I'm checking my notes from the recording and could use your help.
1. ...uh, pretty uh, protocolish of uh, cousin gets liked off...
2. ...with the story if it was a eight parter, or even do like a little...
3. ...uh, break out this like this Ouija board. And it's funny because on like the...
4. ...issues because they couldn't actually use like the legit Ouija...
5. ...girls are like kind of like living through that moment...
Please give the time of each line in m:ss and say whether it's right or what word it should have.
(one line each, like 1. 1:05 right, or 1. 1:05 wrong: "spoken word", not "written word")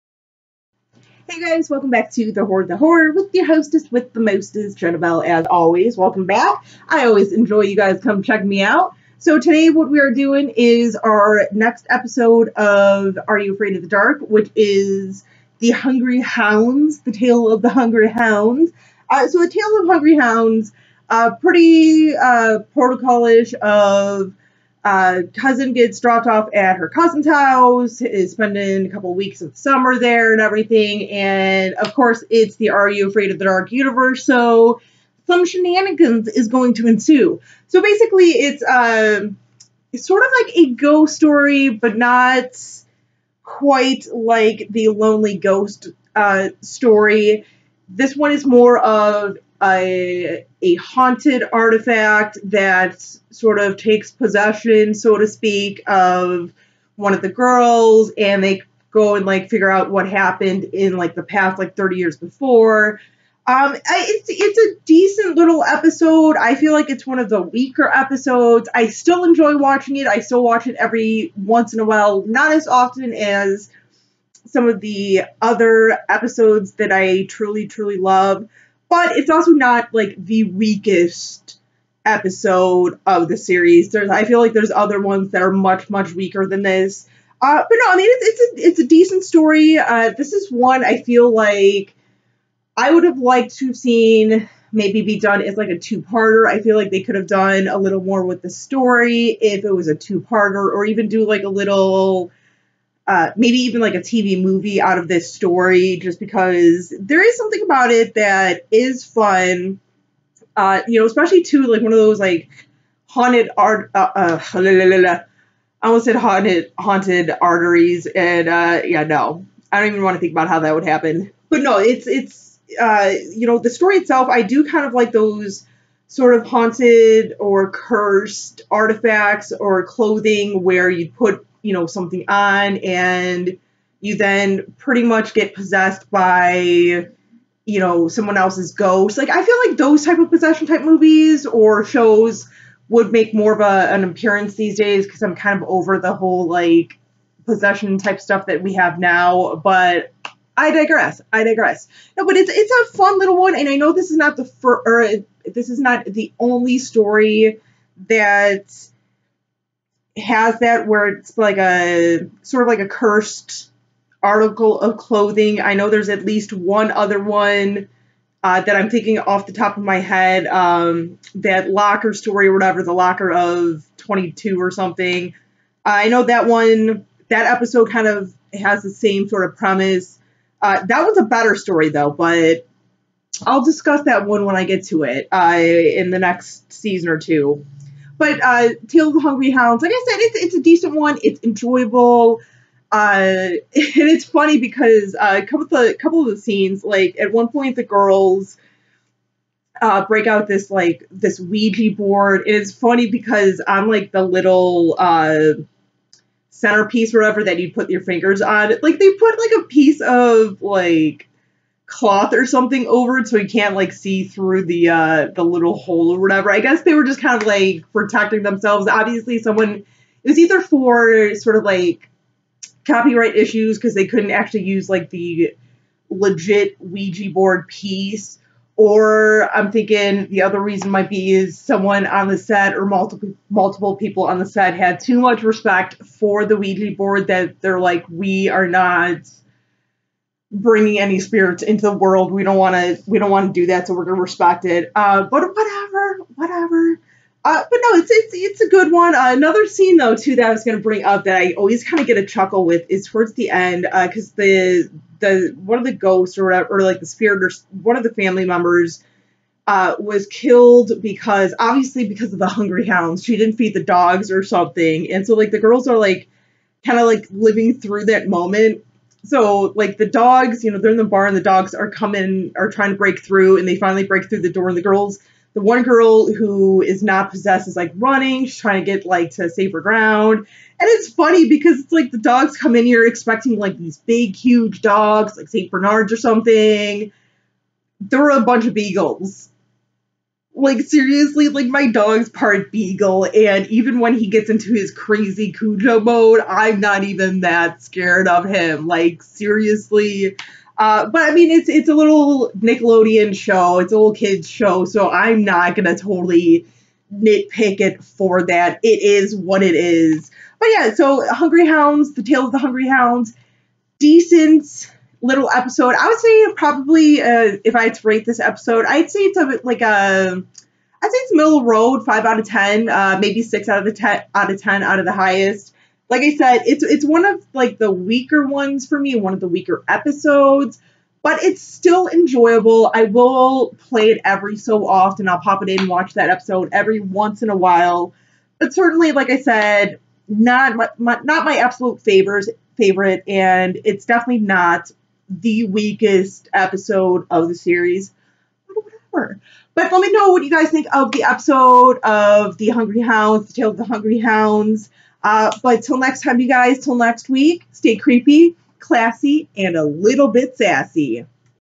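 1. 0:21 wrong: "dropped", not "liked"
2. 1:38 wrong: "two", not "eight"
3. 3:19 right
4. 3:43 right
5. 4:25 right.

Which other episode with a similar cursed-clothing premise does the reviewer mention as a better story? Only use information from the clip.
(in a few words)
The locker of 22.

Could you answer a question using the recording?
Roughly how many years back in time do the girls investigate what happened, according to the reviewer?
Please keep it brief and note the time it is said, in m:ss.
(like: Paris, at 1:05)
30 years, at 1:01.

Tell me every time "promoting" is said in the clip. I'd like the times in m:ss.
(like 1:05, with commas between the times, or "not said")
not said.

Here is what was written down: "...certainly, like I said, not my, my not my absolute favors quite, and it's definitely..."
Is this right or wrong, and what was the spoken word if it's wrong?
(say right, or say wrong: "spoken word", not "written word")
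wrong: "favorite", not "quite".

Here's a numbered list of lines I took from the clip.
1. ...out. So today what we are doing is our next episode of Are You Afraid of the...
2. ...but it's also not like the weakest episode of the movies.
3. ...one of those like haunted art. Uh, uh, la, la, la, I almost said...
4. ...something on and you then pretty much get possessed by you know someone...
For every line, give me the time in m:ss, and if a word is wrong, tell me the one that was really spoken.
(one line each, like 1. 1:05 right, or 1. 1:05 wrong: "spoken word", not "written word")
1. 0:08 right
2. 1:18 wrong: "series", not "movies"
3. 1:51 right
4. 2:11 right.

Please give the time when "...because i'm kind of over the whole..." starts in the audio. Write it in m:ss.
2:25.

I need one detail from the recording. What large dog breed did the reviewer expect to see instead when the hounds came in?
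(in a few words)
Saint Bernards.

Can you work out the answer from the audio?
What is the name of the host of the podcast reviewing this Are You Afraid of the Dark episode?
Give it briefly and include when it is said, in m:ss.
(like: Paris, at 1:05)
Jenabelle, at 0:04.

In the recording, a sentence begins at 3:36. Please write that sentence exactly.
I guess they were just kind of like protecting themselves.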